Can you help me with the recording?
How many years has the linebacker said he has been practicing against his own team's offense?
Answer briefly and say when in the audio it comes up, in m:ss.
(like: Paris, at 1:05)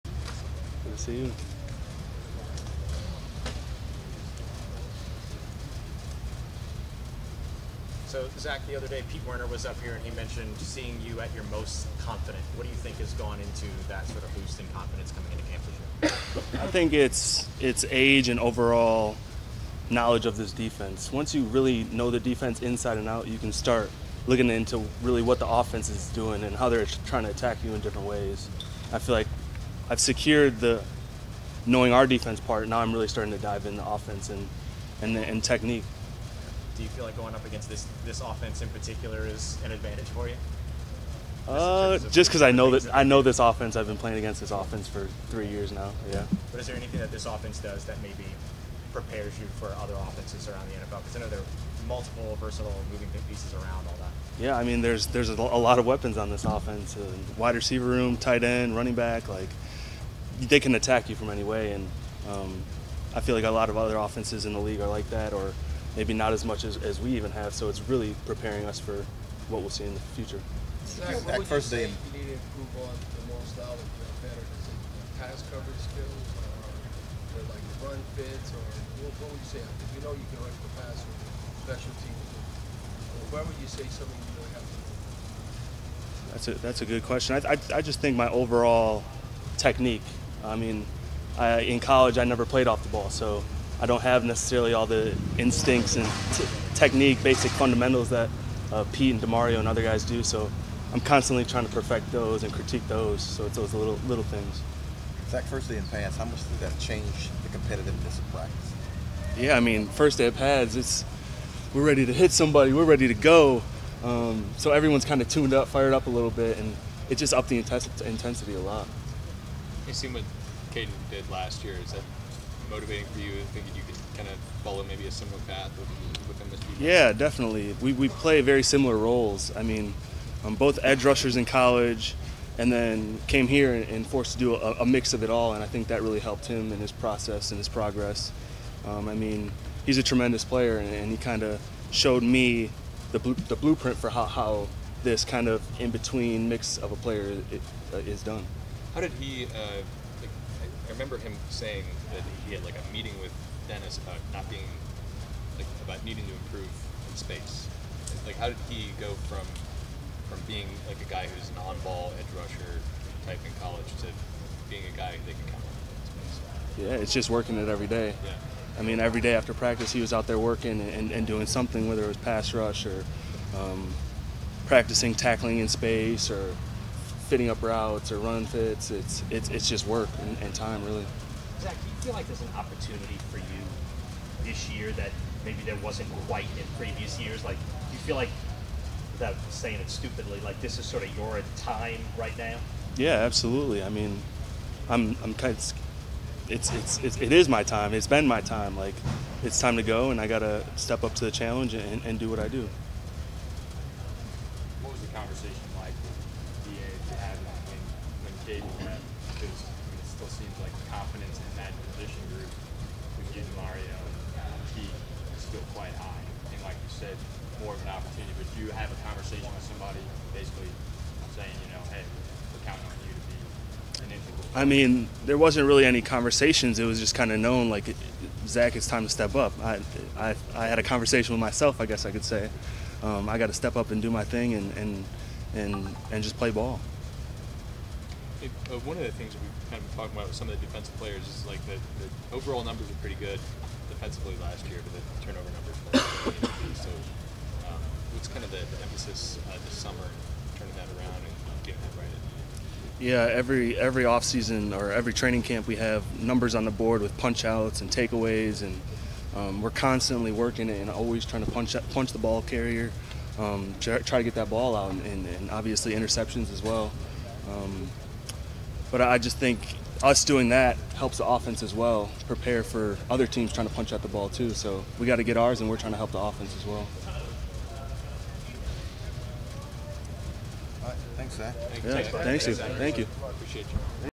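3 years, at 0:45.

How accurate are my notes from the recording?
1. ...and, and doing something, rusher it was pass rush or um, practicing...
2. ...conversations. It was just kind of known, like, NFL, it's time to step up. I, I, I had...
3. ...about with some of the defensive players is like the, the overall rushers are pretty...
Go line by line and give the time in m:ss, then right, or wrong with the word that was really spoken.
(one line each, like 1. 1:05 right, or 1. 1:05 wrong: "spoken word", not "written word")
1. 2:50 wrong: "whether", not "rusher"
2. 3:46 wrong: "Zack", not "NFL"
3. 4:00 wrong: "numbers", not "rushers".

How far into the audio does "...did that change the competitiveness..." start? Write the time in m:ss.
1:46.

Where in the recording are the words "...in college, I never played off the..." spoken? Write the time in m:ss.
1:31.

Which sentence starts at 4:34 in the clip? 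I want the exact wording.
So we got to get ours, and we're trying to help the offense as well.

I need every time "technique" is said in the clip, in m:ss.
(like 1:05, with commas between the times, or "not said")
0:35, 1:29, 1:36.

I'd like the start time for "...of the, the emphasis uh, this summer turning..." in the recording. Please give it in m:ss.
4:08.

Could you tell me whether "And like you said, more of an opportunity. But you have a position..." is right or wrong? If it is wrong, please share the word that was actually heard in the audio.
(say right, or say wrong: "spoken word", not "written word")
wrong: "conversation", not "position".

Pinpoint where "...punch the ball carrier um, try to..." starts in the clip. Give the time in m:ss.
4:21.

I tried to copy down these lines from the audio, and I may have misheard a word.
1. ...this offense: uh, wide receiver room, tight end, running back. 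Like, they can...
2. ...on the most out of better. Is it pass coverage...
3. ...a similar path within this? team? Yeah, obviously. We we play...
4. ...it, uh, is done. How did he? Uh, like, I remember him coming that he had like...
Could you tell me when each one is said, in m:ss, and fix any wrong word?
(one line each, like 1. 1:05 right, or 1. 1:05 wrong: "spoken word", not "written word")
1. 0:56 right
2. 1:12 right
3. 2:05 wrong: "definitely", not "obviously"
4. 2:27 wrong: "saying", not "coming".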